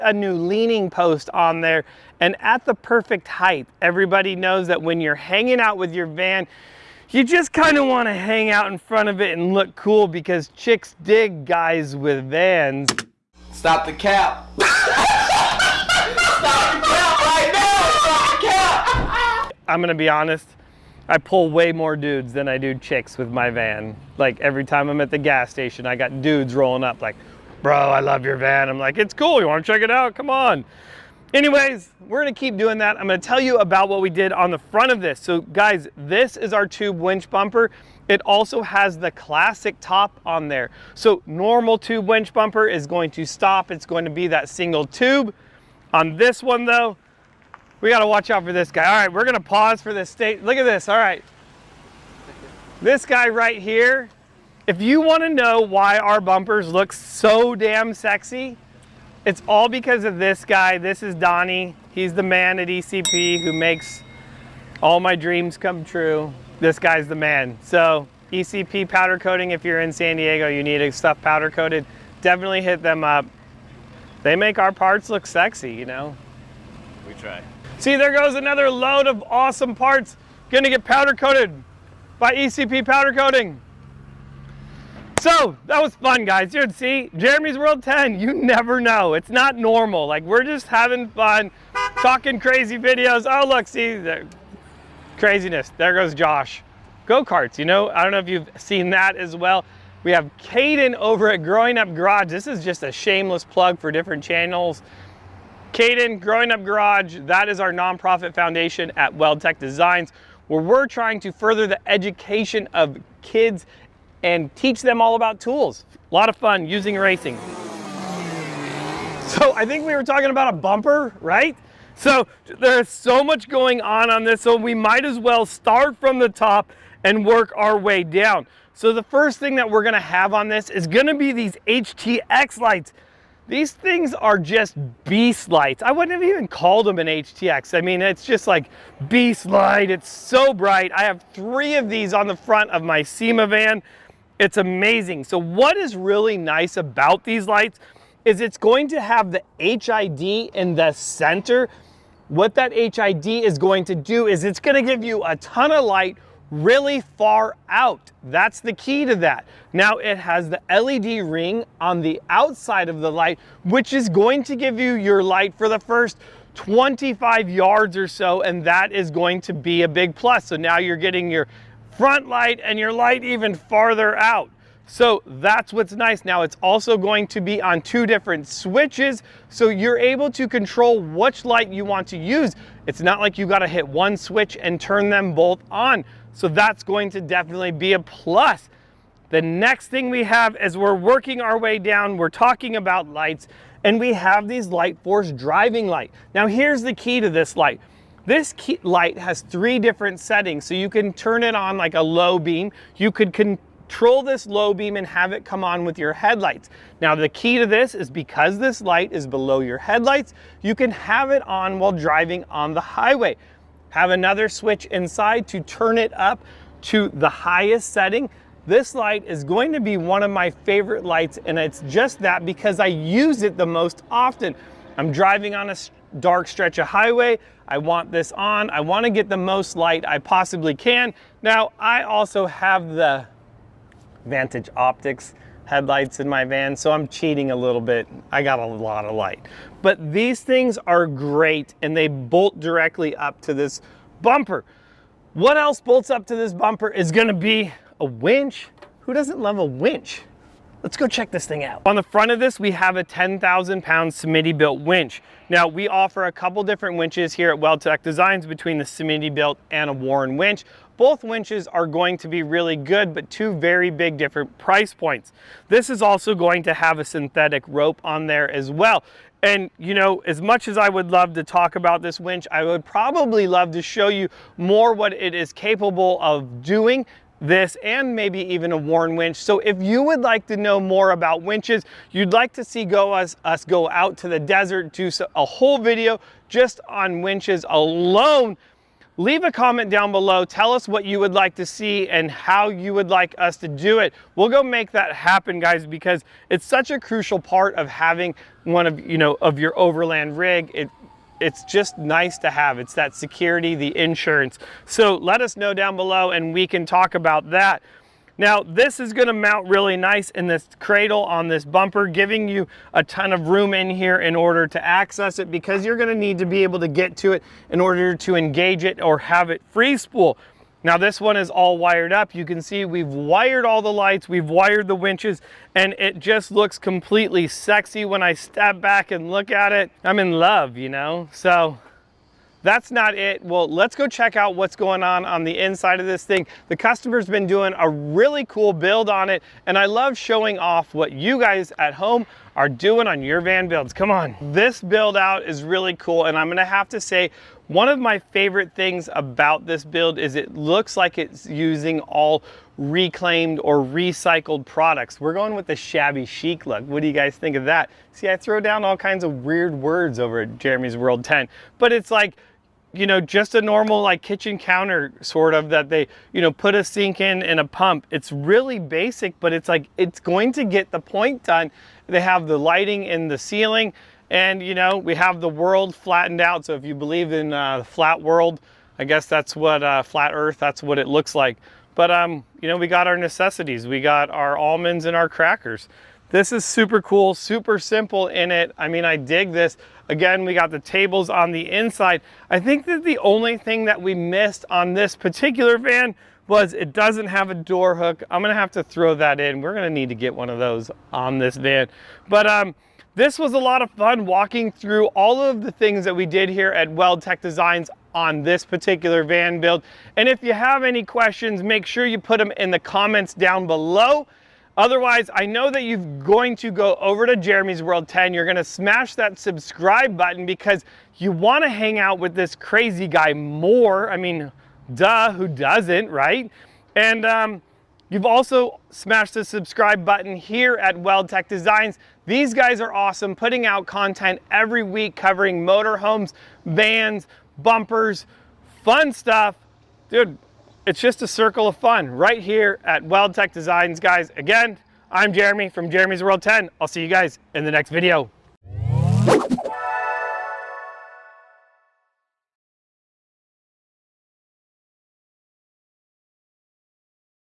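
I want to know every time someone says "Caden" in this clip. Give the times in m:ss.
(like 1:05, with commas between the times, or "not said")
1:40, 1:45.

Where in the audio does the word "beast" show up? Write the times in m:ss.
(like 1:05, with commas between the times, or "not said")
2:15, 2:19.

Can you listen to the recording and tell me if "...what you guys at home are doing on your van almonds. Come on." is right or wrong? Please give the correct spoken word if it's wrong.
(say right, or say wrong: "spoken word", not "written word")
wrong: "builds", not "almonds".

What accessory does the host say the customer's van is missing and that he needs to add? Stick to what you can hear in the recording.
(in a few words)
a door hook.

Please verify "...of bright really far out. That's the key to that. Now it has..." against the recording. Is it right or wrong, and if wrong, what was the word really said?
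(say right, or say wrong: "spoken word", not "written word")
wrong: "light", not "bright".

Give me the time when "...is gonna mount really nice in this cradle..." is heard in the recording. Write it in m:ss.
5:09.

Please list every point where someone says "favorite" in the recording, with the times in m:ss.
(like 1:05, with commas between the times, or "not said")
3:40, 5:48.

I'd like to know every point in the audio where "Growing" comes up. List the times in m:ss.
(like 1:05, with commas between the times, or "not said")
1:41, 1:46.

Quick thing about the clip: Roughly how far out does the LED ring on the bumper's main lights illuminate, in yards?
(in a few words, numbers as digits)
25.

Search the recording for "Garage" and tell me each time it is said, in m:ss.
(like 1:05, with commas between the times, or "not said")
1:41, 1:46.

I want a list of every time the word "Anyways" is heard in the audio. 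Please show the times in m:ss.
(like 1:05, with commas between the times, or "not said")
0:31.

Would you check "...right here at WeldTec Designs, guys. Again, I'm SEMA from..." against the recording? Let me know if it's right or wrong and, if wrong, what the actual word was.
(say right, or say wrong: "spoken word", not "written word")
wrong: "Jeremy", not "SEMA".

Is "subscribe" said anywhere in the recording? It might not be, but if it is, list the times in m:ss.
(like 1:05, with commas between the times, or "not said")
6:59, 7:09.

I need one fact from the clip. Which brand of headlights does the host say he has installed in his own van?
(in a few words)
Vantage Optics.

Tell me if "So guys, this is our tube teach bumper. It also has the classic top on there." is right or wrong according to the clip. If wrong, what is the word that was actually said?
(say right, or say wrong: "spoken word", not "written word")
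wrong: "winch", not "teach".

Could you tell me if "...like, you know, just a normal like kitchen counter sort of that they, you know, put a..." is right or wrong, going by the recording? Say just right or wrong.
right.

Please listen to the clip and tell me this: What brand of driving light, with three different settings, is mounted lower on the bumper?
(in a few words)
Lightforce.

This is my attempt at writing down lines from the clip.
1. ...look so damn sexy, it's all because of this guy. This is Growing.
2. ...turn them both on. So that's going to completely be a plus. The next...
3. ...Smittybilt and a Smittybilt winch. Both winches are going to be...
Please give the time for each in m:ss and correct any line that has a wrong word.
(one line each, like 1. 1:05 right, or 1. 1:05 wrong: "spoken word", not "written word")
1. 0:56 wrong: "Donnie", not "Growing"
2. 3:04 wrong: "definitely", not "completely"
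3. 4:18 wrong: "Warn", not "Smittybilt".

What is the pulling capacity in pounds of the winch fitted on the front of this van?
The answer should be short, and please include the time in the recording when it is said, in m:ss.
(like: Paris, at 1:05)
10,000, at 4:13.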